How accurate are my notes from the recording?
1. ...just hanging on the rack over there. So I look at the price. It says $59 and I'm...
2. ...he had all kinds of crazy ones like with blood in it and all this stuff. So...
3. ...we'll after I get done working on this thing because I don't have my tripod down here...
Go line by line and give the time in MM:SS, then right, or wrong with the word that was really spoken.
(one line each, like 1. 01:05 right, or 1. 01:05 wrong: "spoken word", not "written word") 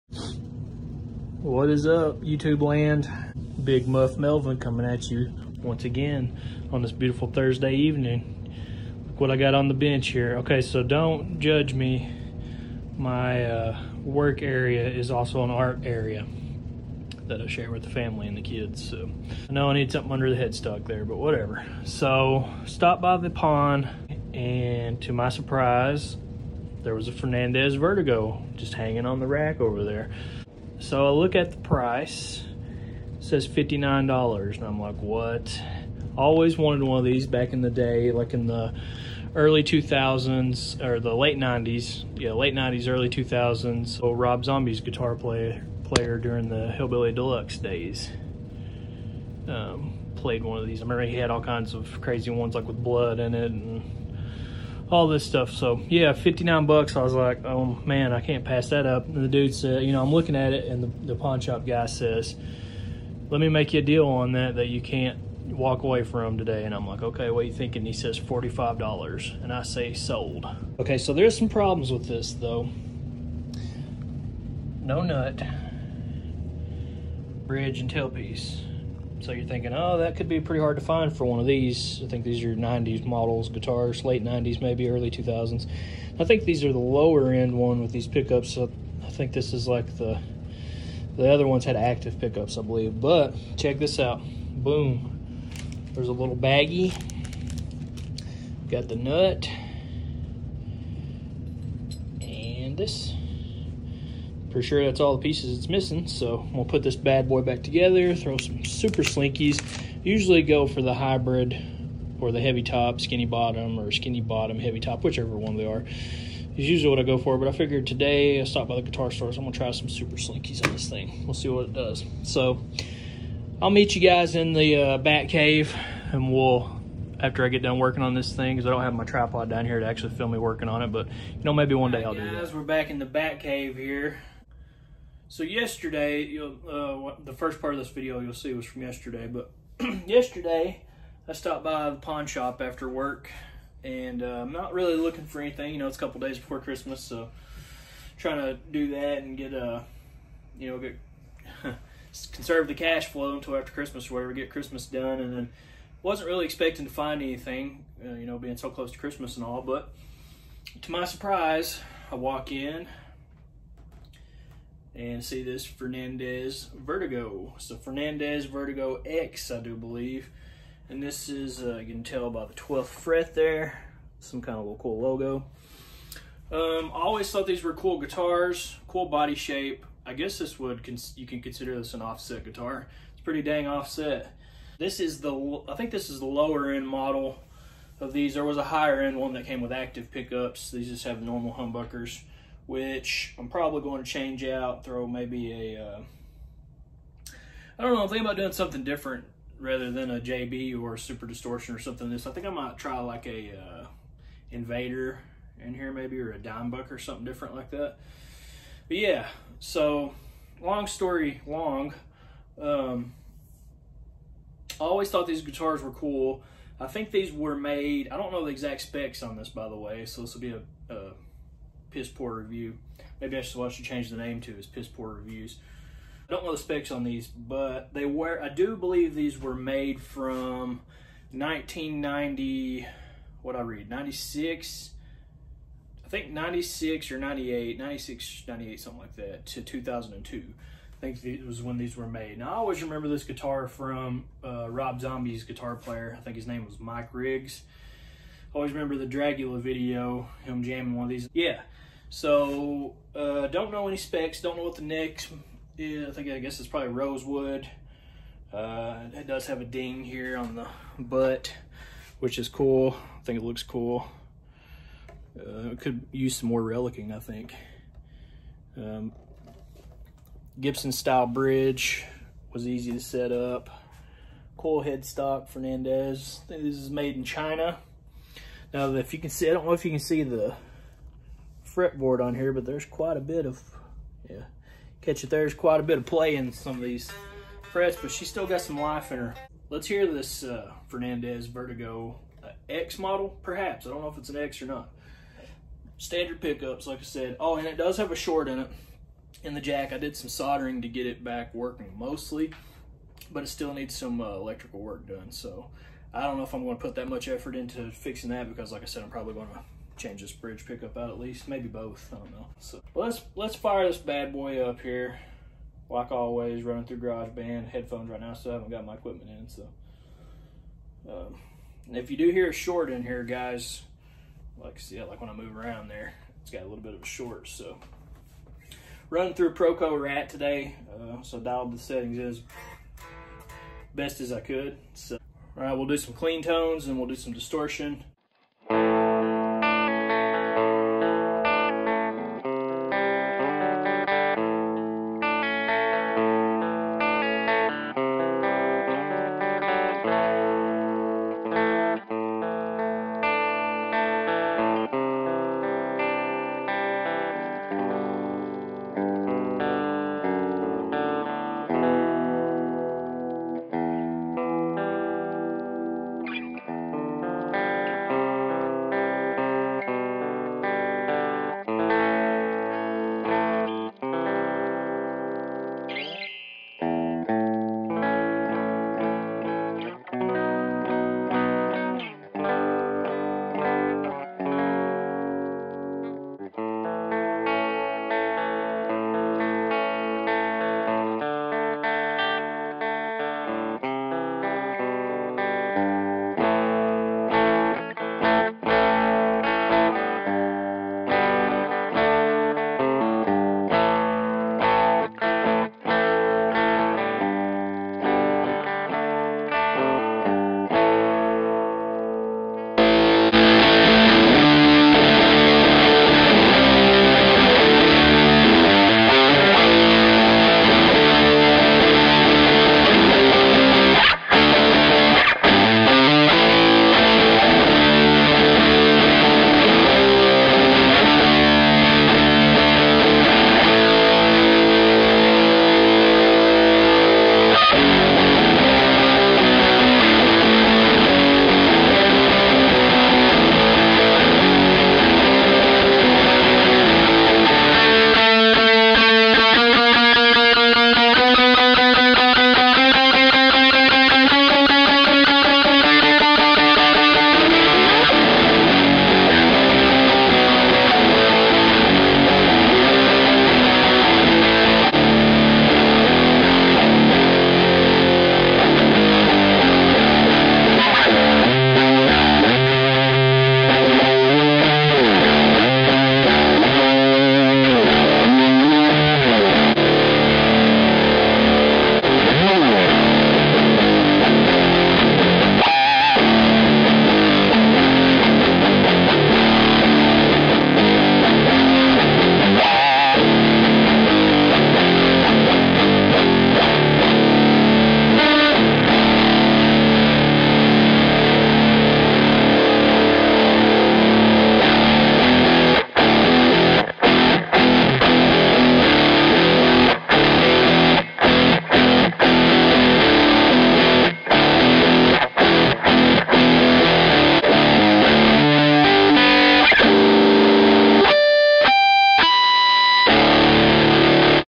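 1. 00:28 right
2. 00:51 right
3. 02:06 right.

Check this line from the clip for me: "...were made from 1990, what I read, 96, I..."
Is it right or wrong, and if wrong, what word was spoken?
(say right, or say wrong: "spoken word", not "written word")
right.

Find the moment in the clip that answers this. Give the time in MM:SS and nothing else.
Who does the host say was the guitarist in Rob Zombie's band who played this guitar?
04:06.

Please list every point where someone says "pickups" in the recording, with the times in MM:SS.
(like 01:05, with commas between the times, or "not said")
01:28, 01:32, 03:10, 04:56, 05:10.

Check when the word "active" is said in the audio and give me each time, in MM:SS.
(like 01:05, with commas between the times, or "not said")
01:31, 03:09.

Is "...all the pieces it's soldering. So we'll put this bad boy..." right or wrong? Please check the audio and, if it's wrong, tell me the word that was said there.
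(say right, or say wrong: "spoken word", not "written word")
wrong: "missing", not "soldering".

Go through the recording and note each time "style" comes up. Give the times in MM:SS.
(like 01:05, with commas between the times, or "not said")
04:30.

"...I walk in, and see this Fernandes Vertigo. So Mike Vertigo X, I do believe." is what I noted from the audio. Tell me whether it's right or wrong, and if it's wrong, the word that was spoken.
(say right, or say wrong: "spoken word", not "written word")
wrong: "Fernandes", not "Mike".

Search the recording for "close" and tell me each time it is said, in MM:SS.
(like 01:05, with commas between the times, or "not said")
02:38.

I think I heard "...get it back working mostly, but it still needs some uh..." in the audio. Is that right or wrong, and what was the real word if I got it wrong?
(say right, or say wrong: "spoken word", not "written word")
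right.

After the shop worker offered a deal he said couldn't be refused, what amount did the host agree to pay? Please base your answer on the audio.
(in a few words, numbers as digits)
$45.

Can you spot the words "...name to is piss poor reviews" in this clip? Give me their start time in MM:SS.
03:44.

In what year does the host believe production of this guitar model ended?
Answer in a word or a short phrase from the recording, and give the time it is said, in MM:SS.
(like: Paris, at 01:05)
2002, at 03:59.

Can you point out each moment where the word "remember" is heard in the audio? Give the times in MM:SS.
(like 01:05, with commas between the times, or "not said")
00:50, 04:02, 04:08.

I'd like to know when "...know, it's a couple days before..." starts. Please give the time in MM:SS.
02:25.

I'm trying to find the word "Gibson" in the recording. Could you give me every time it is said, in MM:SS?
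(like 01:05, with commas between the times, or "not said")
04:30.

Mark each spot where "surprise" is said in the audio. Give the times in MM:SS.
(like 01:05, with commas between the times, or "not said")
00:25, 02:41.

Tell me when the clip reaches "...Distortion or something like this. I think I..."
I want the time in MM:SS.
03:21.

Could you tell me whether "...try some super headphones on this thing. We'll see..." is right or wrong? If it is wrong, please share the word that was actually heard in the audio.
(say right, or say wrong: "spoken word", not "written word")
wrong: "slinkies", not "headphones".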